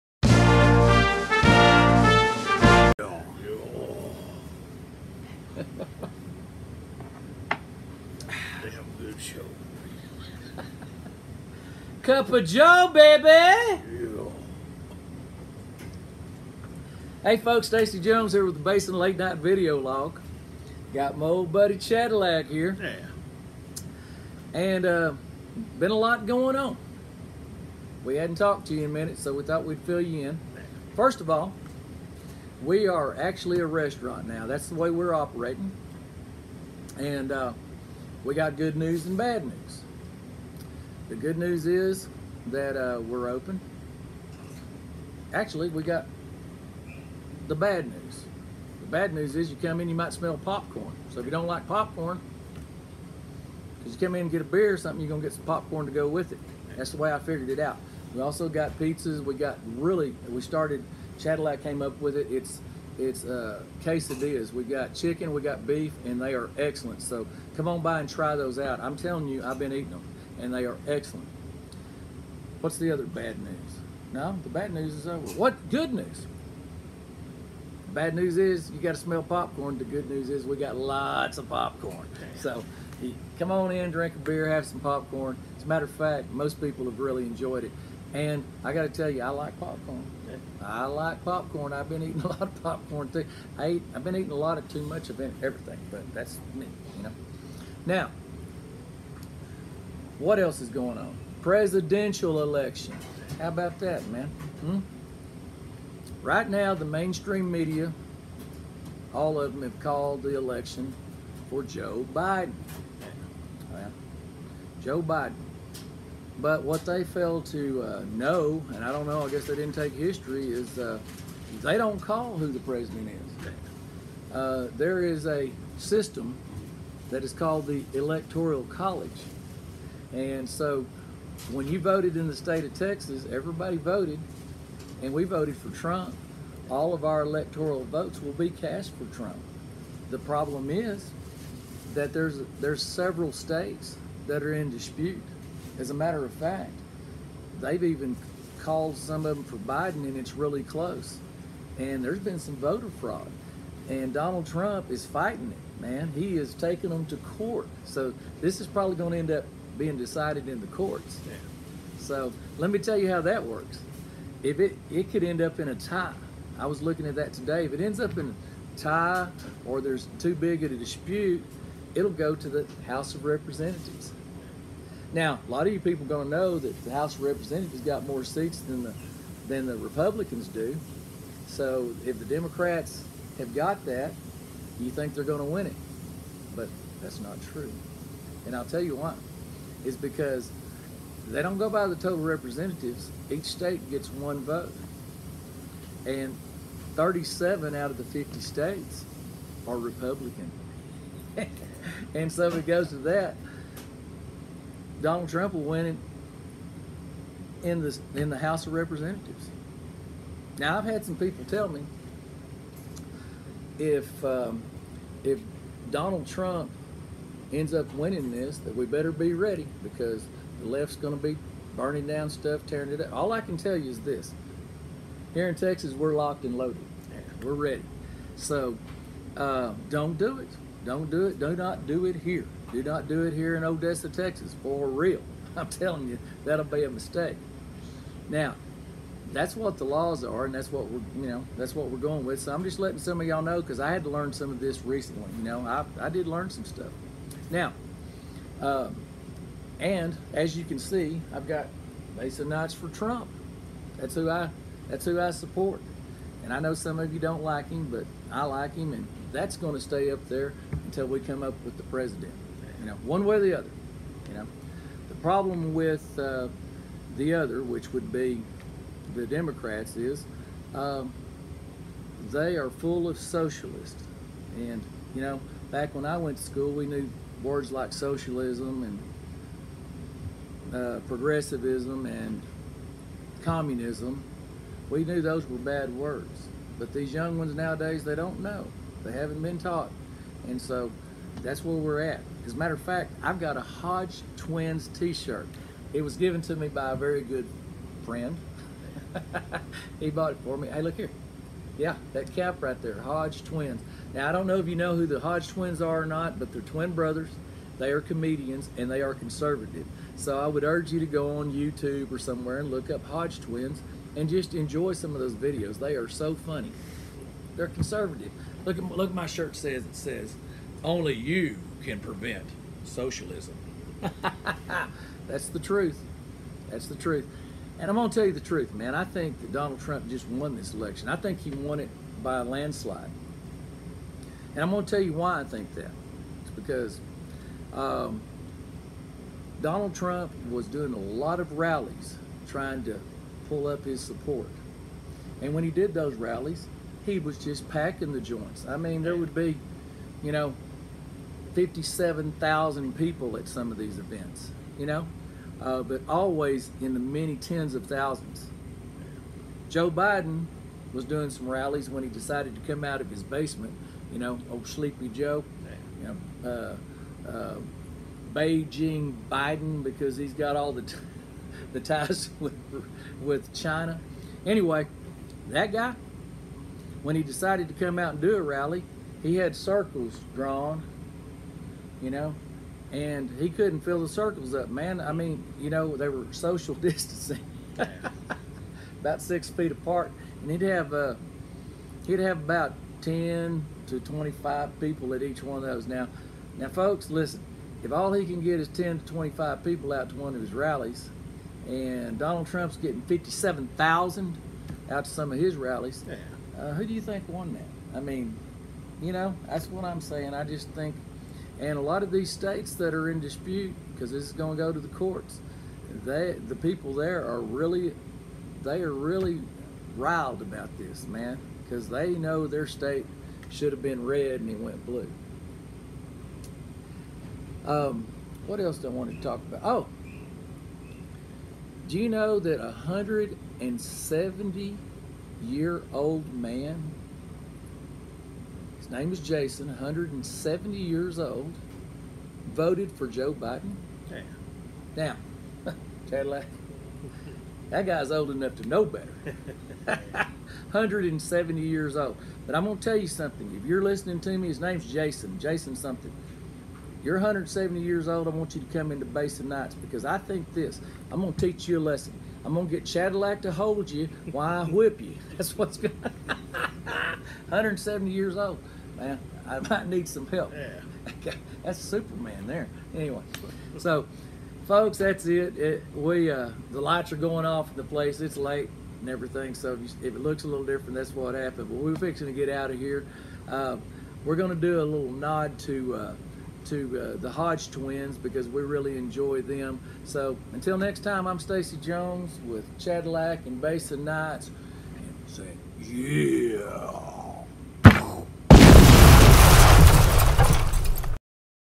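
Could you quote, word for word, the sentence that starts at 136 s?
All of our electoral votes will be cast for Trump.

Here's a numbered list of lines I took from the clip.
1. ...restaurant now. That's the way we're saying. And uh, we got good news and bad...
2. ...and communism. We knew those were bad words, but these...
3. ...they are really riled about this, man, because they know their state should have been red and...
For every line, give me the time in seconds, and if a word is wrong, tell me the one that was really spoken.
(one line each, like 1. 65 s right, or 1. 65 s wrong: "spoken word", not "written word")
1. 33 s wrong: "operating", not "saying"
2. 282 s right
3. 418 s right.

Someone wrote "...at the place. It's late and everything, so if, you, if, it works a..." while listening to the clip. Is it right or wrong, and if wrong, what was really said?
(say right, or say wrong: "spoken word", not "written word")
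wrong: "looks", not "works".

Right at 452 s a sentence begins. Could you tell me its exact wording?
But I'm going to tell you something.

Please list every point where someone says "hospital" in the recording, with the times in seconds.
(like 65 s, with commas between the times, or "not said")
not said.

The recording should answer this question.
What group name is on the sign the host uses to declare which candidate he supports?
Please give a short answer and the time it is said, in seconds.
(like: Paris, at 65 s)
Masonites for Trump, at 252 s.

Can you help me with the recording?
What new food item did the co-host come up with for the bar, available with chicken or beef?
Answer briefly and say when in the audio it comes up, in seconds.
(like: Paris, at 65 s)
Quesadillas, at 63 s.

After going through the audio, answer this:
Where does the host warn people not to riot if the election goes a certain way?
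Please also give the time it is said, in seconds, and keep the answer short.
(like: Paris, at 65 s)
Odessa, Texas, at 233 s.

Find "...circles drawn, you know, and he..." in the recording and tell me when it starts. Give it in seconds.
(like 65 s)
379 s.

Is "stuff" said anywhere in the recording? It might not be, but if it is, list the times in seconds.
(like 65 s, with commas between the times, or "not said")
222 s, 246 s.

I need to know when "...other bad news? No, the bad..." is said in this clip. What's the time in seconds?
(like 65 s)
72 s.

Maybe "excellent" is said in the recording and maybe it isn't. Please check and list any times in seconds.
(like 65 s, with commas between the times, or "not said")
66 s, 70 s.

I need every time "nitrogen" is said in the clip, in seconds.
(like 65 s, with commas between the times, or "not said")
not said.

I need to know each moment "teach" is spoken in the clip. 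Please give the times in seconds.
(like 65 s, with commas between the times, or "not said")
461 s.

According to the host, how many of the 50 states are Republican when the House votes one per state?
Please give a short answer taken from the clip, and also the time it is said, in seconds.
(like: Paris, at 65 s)
37, at 196 s.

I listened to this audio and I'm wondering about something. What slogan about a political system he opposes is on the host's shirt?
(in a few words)
Only you can prevent socialism.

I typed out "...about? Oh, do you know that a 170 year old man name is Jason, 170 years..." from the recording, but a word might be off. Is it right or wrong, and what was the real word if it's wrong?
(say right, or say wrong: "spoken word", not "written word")
right.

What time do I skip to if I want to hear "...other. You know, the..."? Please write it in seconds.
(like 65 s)
263 s.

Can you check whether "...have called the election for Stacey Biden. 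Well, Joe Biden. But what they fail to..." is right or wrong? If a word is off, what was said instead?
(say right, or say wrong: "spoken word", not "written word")
wrong: "Joe", not "Stacey".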